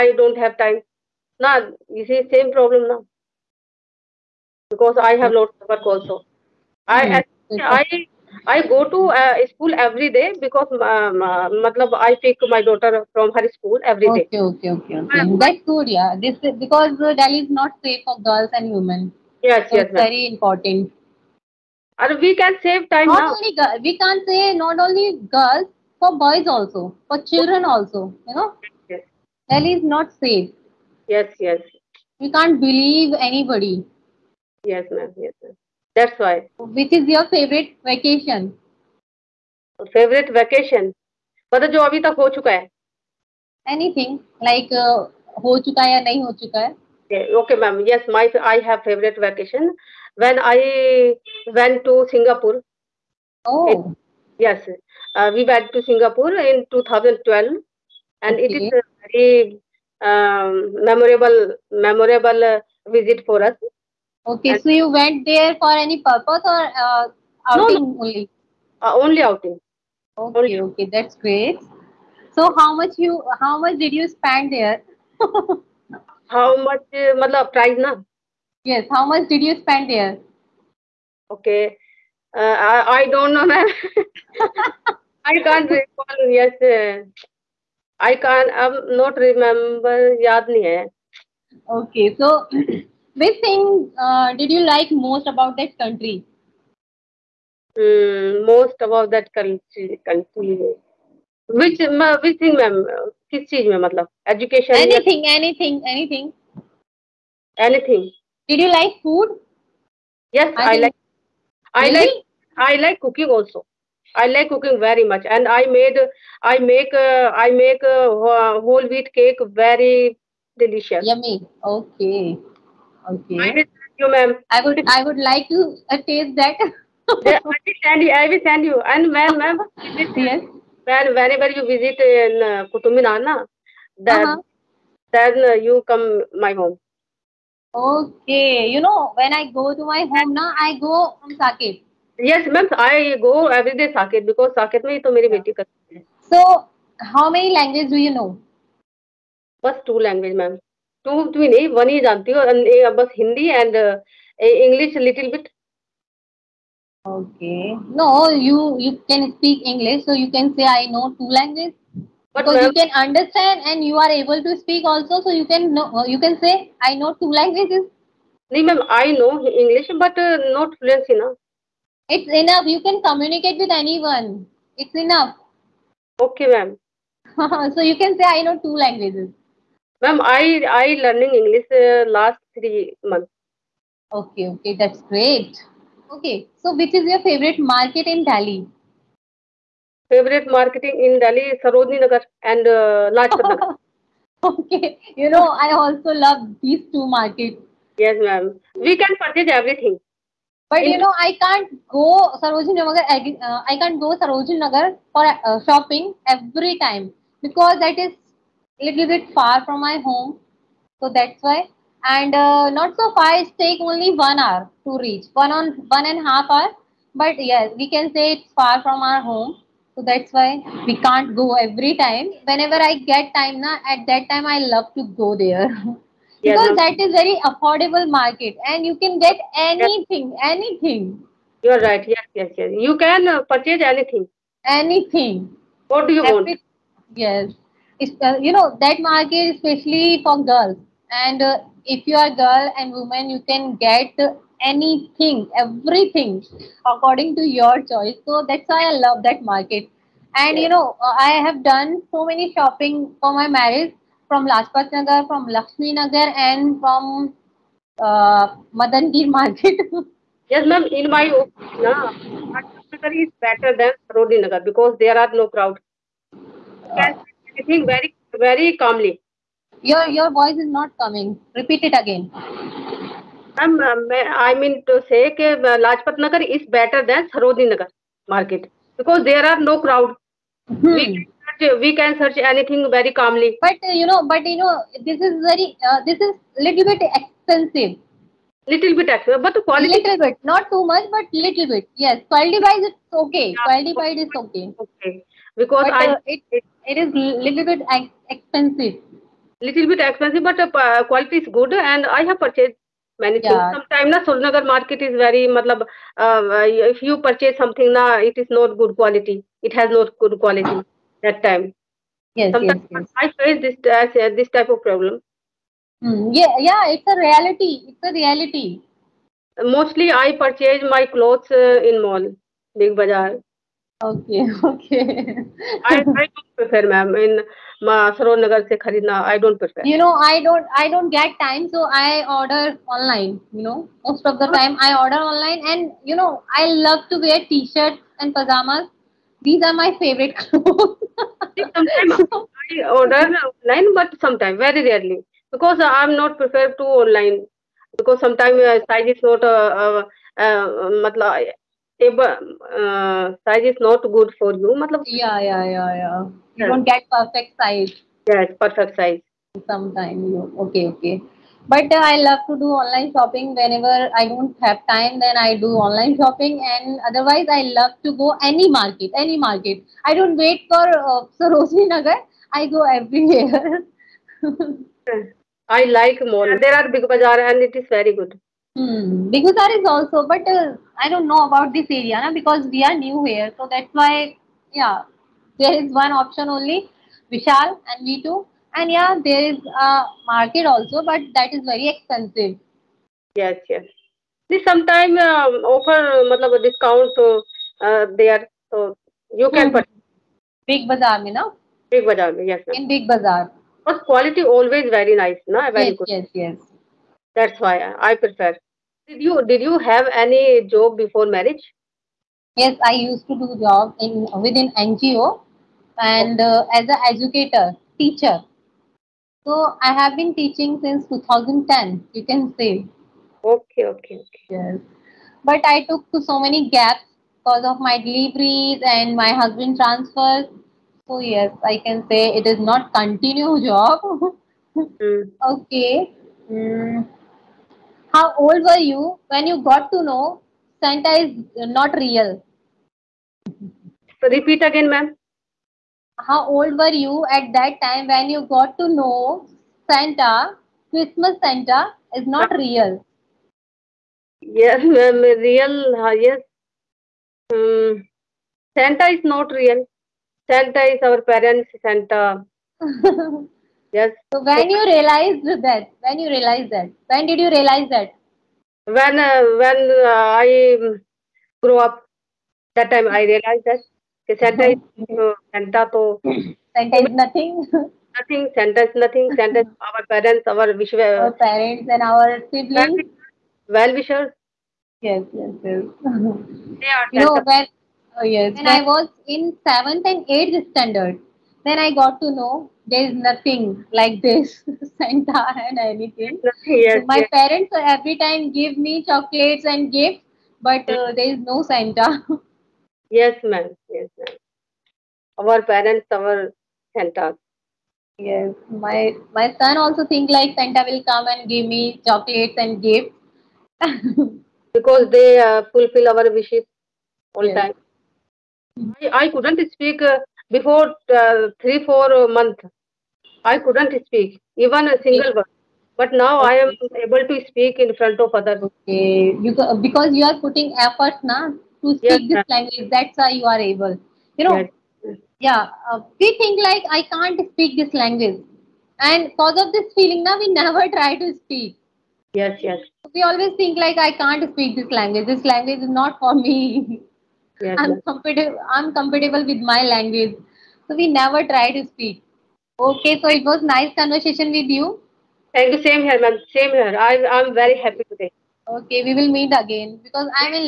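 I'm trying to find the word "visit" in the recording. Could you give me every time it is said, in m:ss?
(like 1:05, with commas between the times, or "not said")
1:02, 2:11.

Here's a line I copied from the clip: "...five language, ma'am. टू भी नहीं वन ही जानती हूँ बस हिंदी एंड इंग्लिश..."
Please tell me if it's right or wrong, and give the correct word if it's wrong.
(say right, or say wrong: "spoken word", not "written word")
wrong: "two", not "five".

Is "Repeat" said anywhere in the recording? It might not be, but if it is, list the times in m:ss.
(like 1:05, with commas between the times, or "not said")
4:31, 7:24.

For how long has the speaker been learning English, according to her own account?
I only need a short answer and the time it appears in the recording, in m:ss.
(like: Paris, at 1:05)
three months, at 3:02.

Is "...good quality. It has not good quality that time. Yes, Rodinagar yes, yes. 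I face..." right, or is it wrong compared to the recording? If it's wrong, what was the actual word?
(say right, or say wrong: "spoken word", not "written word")
wrong: "Sometimes", not "Rodinagar".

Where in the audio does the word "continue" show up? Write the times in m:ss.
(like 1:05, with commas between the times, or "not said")
7:12.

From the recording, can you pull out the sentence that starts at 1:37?
Mm, most about that country, country.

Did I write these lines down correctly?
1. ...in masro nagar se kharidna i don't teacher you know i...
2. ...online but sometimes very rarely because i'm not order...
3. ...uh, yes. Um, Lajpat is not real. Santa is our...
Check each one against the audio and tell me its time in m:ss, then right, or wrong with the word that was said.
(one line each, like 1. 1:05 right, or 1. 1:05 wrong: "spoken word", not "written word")
1. 5:27 wrong: "prefer", not "teacher"
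2. 5:43 wrong: "prefer", not "order"
3. 7:36 wrong: "Santa", not "Lajpat".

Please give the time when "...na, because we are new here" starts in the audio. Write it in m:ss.
6:22.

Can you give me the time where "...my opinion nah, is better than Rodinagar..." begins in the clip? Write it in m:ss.
4:21.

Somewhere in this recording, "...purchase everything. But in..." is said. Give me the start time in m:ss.
3:19.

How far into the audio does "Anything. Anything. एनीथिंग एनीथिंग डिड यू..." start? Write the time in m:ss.
1:45.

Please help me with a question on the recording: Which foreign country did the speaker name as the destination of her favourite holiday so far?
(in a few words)
Singapore.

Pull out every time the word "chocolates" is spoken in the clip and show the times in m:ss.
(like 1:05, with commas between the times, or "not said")
8:19, 8:32.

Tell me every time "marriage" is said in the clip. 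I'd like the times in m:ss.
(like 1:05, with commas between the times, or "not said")
4:13, 6:51.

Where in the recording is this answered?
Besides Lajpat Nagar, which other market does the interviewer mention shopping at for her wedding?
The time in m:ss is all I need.
4:15.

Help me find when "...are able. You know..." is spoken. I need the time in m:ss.
8:53.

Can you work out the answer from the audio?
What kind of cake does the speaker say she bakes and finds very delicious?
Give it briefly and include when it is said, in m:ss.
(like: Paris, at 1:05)
whole wheat cake, at 1:58.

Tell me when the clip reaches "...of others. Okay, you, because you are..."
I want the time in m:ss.
8:48.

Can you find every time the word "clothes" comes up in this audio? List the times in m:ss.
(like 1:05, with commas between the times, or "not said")
5:21, 5:40.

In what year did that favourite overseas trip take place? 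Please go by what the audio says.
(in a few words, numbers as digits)
2012.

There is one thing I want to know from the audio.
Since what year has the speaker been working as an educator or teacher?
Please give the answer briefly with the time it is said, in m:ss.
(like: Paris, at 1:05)
2010, at 7:01.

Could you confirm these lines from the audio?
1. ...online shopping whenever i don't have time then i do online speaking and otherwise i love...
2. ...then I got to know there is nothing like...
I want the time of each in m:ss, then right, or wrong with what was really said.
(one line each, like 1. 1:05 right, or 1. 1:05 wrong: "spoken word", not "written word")
1. 6:02 wrong: "shopping", not "speaking"
2. 8:11 right.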